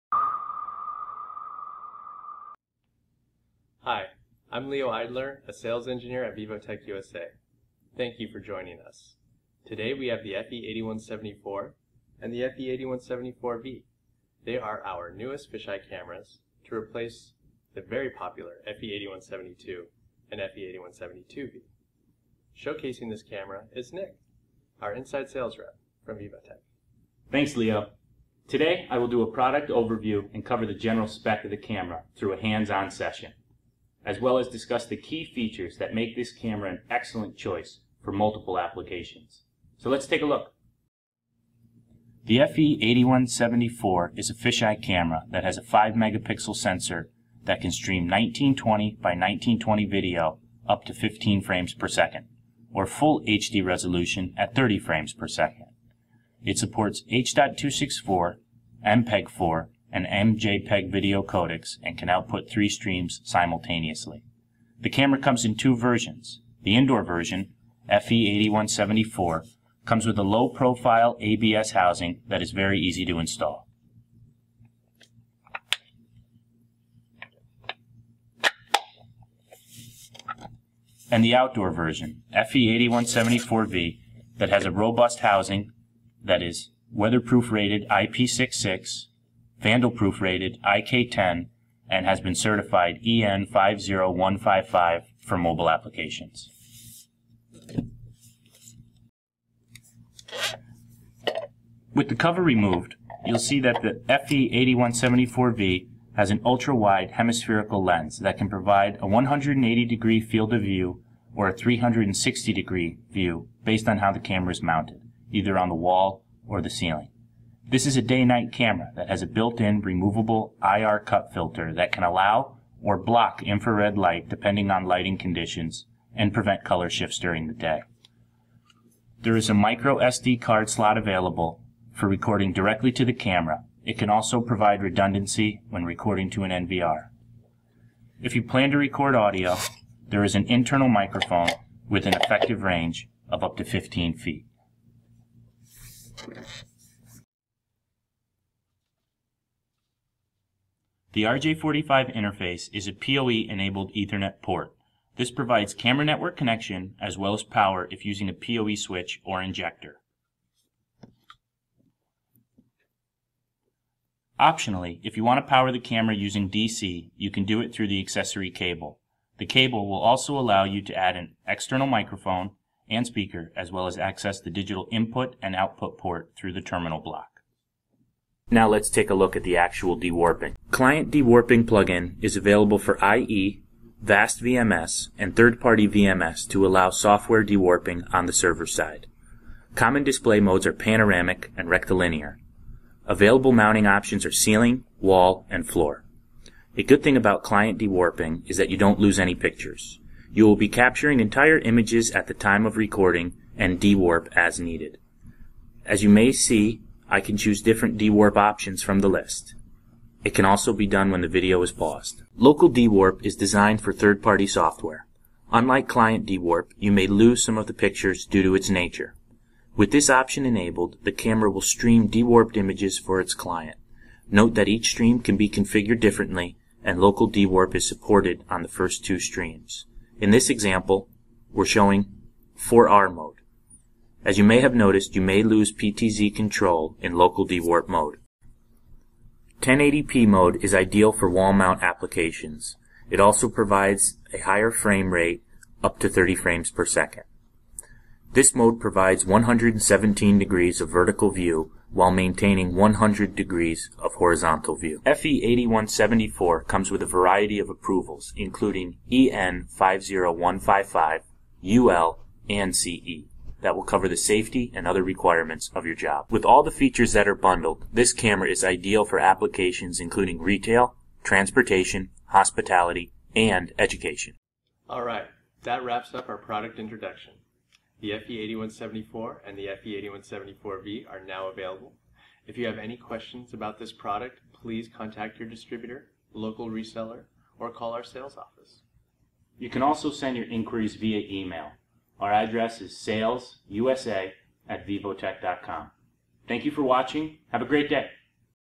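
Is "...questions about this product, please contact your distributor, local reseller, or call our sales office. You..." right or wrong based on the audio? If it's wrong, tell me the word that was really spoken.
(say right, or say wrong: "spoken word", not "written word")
right.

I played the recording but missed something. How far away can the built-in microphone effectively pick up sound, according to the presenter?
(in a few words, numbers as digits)
15 feet.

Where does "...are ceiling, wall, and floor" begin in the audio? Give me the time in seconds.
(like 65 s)
194 s.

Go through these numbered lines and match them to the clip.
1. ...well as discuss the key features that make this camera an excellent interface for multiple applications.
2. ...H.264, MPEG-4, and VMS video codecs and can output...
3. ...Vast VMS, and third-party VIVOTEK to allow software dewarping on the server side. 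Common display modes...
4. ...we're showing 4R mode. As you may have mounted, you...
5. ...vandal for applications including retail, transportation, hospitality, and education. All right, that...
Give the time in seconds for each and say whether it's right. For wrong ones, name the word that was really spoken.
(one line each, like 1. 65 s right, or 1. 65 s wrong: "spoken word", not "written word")
1. 34 s wrong: "choice", not "interface"
2. 57 s wrong: "MJPEG", not "VMS"
3. 184 s wrong: "VMS", not "VIVOTEK"
4. 231 s wrong: "noticed", not "mounted"
5. 268 s wrong: "ideal", not "vandal".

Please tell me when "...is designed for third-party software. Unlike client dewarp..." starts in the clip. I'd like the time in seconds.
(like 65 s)
213 s.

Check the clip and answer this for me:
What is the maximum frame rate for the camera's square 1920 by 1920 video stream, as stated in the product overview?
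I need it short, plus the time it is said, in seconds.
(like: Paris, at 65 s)
15 frames per second, at 50 s.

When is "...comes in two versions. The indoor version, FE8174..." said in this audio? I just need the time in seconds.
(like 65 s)
65 s.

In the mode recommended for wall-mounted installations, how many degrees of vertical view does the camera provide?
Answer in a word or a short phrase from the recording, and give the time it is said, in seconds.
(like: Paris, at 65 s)
117 degrees, at 249 s.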